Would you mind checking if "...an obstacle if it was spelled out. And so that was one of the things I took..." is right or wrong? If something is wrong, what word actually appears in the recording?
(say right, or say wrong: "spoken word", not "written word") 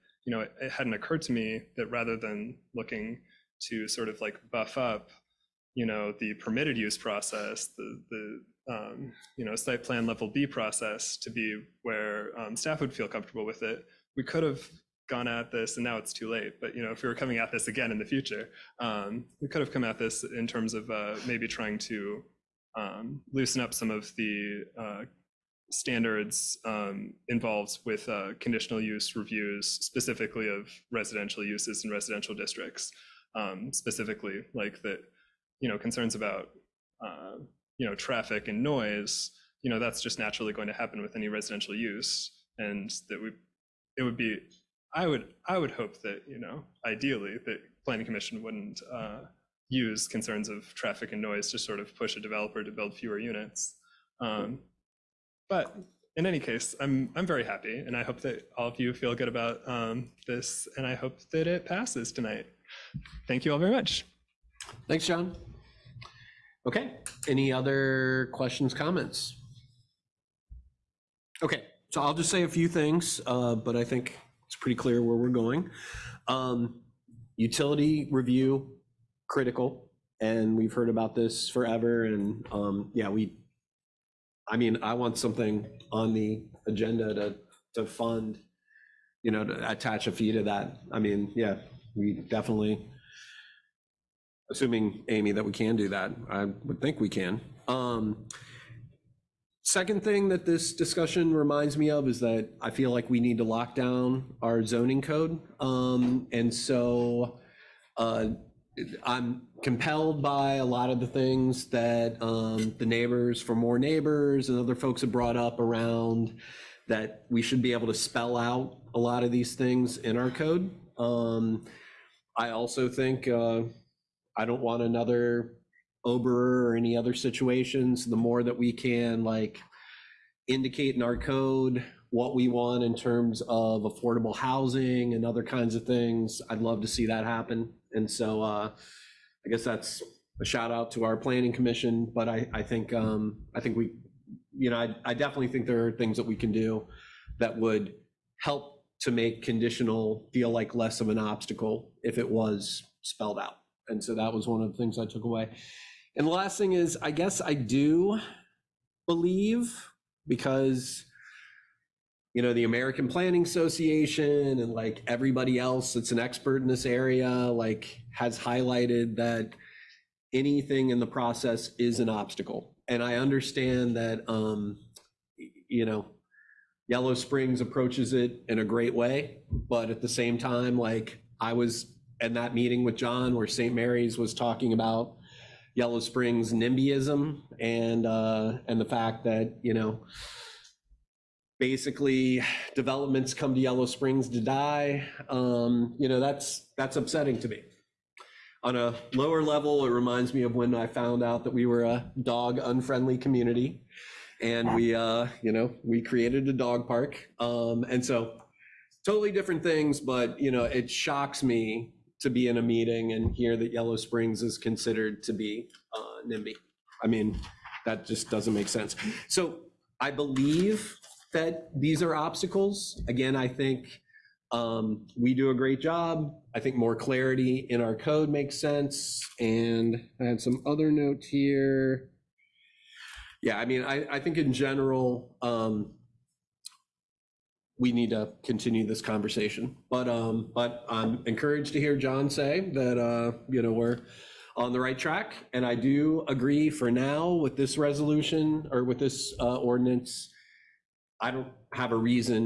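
right.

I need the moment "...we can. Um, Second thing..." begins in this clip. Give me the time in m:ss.
1:36.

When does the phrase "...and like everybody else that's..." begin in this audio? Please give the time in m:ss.
2:44.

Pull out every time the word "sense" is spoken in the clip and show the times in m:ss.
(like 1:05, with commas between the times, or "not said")
3:38, 3:48.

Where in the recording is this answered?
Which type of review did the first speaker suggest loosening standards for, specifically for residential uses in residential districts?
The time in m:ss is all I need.
0:28.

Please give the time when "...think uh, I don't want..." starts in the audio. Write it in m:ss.
2:02.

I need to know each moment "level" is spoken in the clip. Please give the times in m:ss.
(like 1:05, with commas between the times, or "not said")
0:10, 3:19.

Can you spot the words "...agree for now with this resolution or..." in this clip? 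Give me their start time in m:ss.
4:06.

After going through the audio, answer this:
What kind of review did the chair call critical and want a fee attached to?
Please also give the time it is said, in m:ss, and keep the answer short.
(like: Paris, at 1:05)
Utility review, at 1:17.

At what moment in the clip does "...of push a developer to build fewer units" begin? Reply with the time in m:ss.
0:51.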